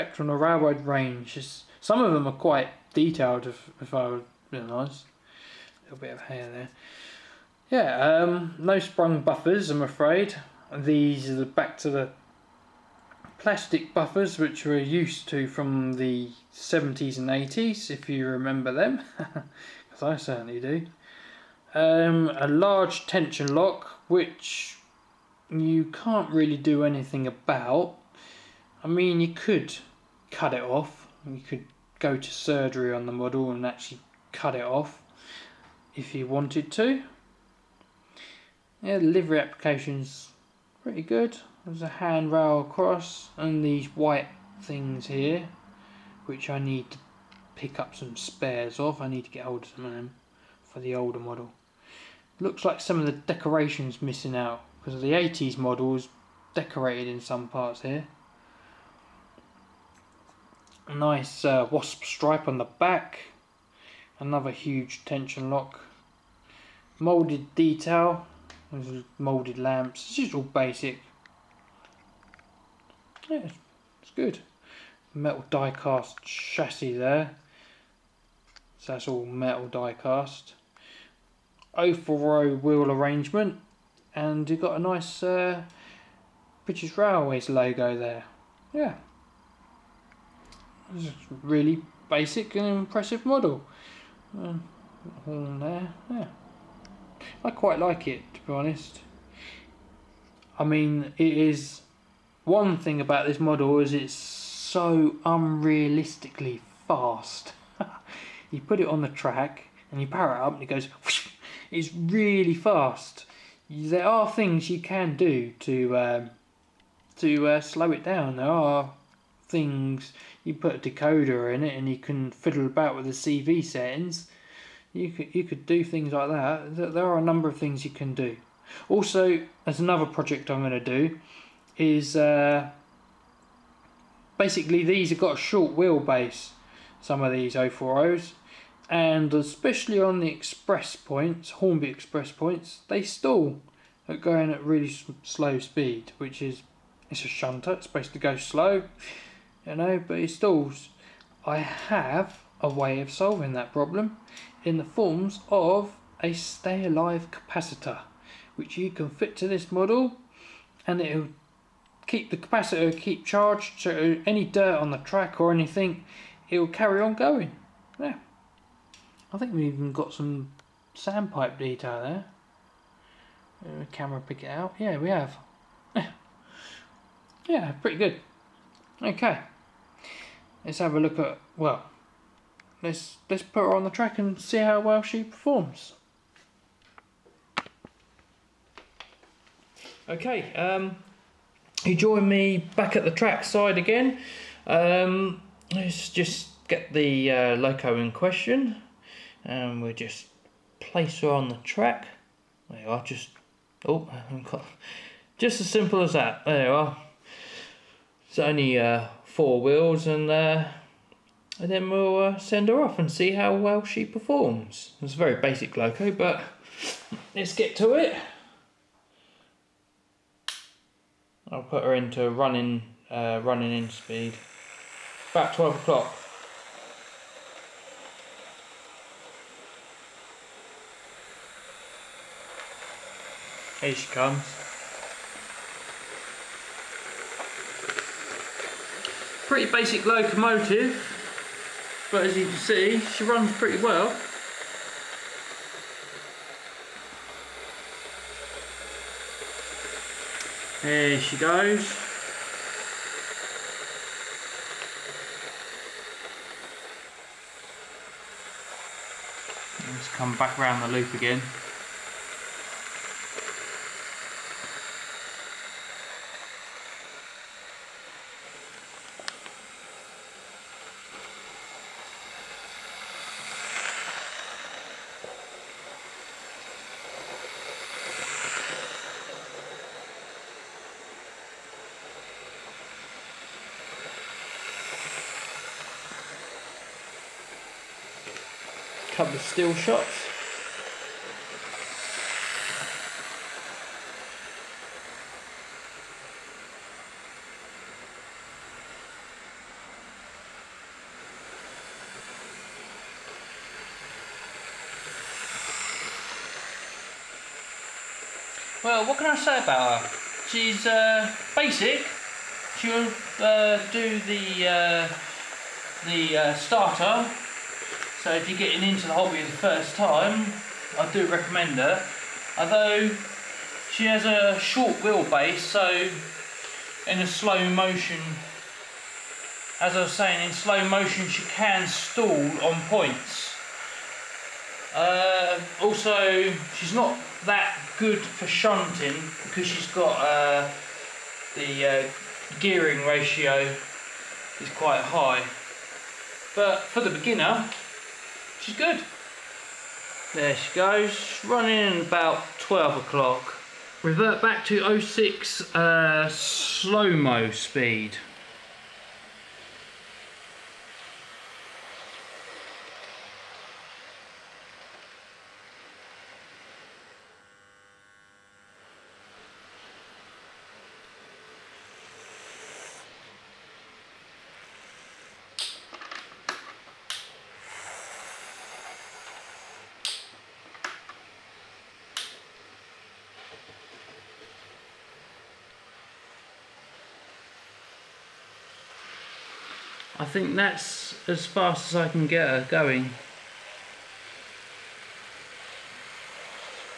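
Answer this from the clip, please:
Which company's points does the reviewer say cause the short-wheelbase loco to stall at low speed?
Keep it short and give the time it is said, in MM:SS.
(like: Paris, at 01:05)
Hornby, at 02:21.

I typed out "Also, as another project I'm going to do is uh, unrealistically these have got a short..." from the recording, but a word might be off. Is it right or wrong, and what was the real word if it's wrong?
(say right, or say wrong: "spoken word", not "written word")
wrong: "basically", not "unrealistically".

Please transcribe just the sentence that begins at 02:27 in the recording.
It's supposed to go slow, you know, but it stalls.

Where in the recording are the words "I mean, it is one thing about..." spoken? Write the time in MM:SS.
01:40.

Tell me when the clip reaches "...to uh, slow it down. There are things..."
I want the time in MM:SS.
01:57.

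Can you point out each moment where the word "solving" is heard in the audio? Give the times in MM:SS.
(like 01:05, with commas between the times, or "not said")
02:33.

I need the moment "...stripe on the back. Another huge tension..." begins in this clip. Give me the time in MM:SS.
01:02.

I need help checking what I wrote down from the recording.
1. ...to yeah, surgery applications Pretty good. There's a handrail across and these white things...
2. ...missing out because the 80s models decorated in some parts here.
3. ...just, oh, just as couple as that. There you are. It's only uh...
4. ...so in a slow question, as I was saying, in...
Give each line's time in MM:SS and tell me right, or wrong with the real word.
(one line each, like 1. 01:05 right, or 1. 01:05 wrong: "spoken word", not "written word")
1. 00:36 wrong: "livery", not "surgery"
2. 00:54 right
3. 03:23 wrong: "simple", not "couple"
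4. 05:25 wrong: "motion", not "question".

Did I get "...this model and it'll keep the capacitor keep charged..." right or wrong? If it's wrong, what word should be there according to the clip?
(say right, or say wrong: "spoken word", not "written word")
right.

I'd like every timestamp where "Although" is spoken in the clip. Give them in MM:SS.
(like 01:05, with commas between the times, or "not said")
05:22.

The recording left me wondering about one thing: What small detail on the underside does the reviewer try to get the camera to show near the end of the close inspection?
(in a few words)
Sandpipe detail.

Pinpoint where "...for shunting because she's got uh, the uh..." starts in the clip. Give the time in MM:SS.
05:38.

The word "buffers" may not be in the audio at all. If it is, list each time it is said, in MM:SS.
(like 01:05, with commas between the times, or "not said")
00:09, 00:13.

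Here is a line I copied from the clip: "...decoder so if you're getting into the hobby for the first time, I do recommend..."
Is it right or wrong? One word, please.
wrong.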